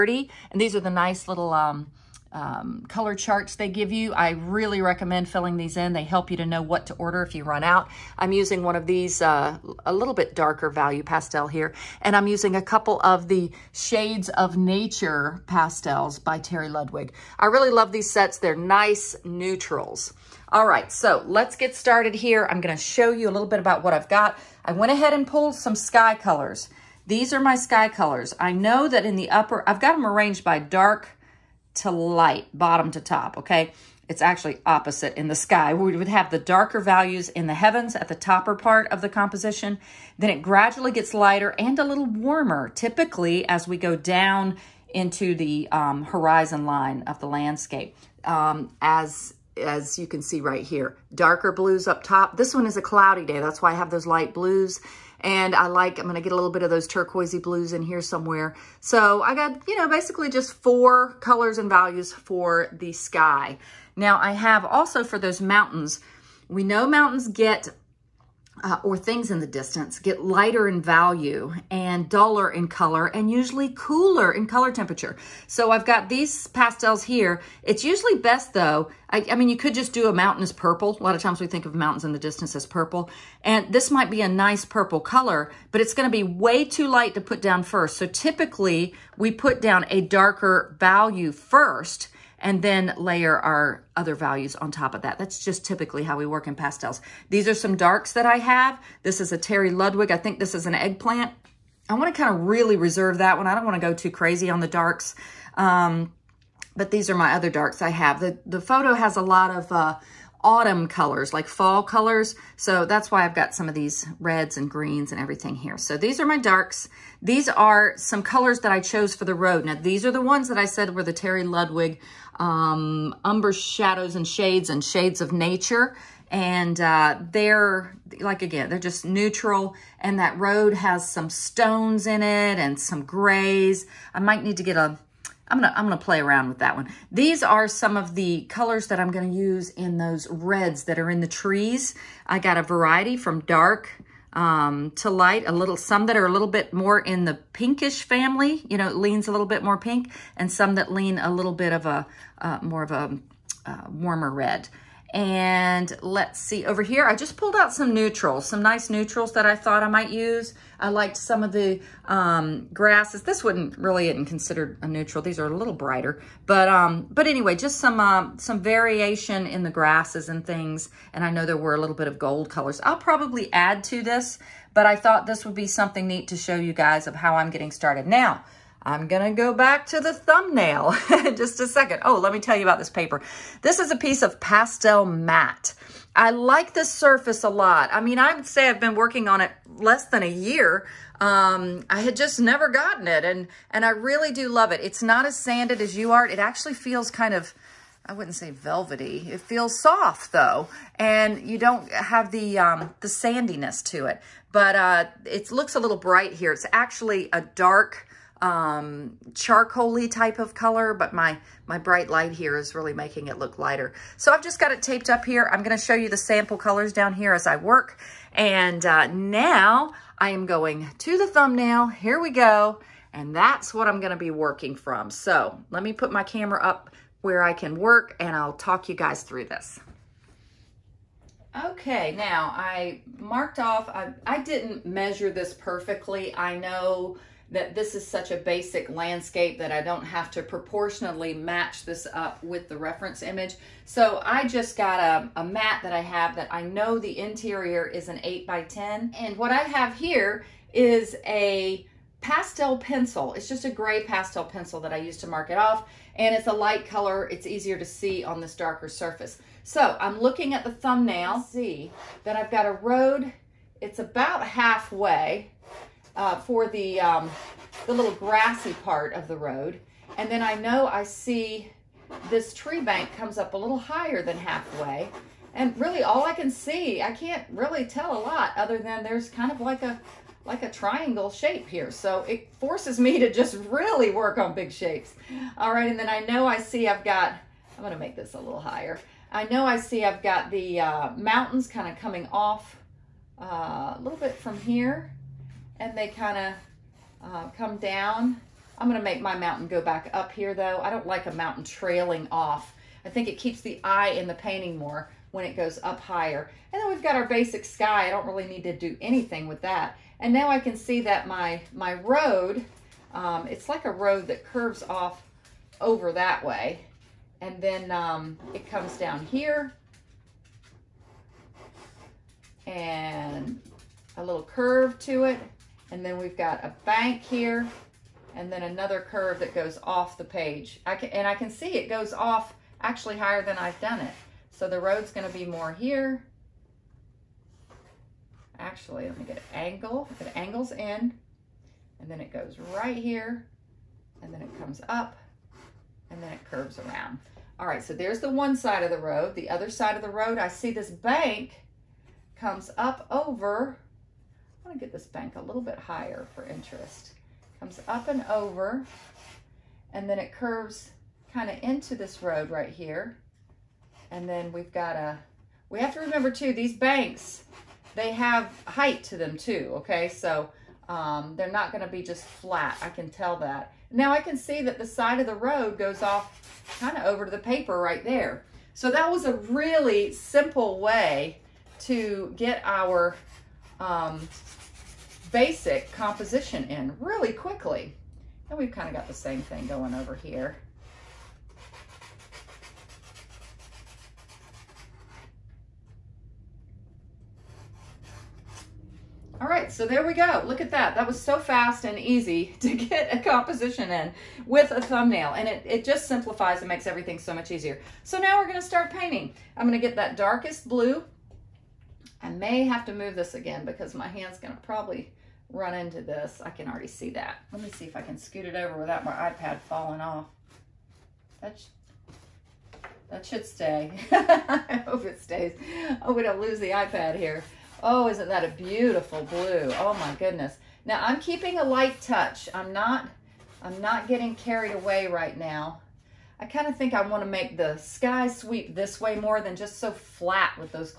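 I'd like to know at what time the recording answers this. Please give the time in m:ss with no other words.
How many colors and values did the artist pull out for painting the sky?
1:00.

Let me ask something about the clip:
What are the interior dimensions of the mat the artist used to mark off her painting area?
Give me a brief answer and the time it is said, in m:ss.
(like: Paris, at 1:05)
8 by 10, at 4:08.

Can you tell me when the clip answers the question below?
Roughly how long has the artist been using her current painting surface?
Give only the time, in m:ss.
3:09.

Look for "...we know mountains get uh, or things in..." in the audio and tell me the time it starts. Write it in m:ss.
1:06.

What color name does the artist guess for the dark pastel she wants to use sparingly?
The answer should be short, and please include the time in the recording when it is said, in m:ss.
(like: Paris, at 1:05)
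Eggplant, at 1:40.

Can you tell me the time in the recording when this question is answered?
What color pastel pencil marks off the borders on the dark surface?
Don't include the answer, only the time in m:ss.
4:13.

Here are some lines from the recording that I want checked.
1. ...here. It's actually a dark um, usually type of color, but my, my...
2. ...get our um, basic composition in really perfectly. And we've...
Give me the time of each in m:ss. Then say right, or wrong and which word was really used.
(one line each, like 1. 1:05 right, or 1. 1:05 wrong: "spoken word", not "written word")
1. 3:26 wrong: "charcoaly", not "usually"
2. 6:22 wrong: "quickly", not "perfectly".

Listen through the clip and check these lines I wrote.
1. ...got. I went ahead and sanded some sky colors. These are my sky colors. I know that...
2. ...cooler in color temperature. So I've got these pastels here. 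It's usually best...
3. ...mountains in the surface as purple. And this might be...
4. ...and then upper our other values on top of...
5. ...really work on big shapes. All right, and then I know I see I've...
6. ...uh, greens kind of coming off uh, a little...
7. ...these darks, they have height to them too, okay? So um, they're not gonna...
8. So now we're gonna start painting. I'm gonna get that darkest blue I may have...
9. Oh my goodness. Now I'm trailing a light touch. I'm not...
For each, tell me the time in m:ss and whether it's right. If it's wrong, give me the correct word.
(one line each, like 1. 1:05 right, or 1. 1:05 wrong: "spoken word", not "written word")
1. 0:24 wrong: "pulled", not "sanded"
2. 1:13 right
3. 1:21 wrong: "distance", not "surface"
4. 1:32 wrong: "layer", not "upper"
5. 4:43 right
6. 4:50 wrong: "mountains", not "greens"
7. 6:06 wrong: "banks", not "darks"
8. 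6:48 right
9. 7:09 wrong: "keeping", not "trailing".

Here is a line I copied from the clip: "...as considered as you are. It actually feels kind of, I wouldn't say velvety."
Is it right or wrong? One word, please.
wrong.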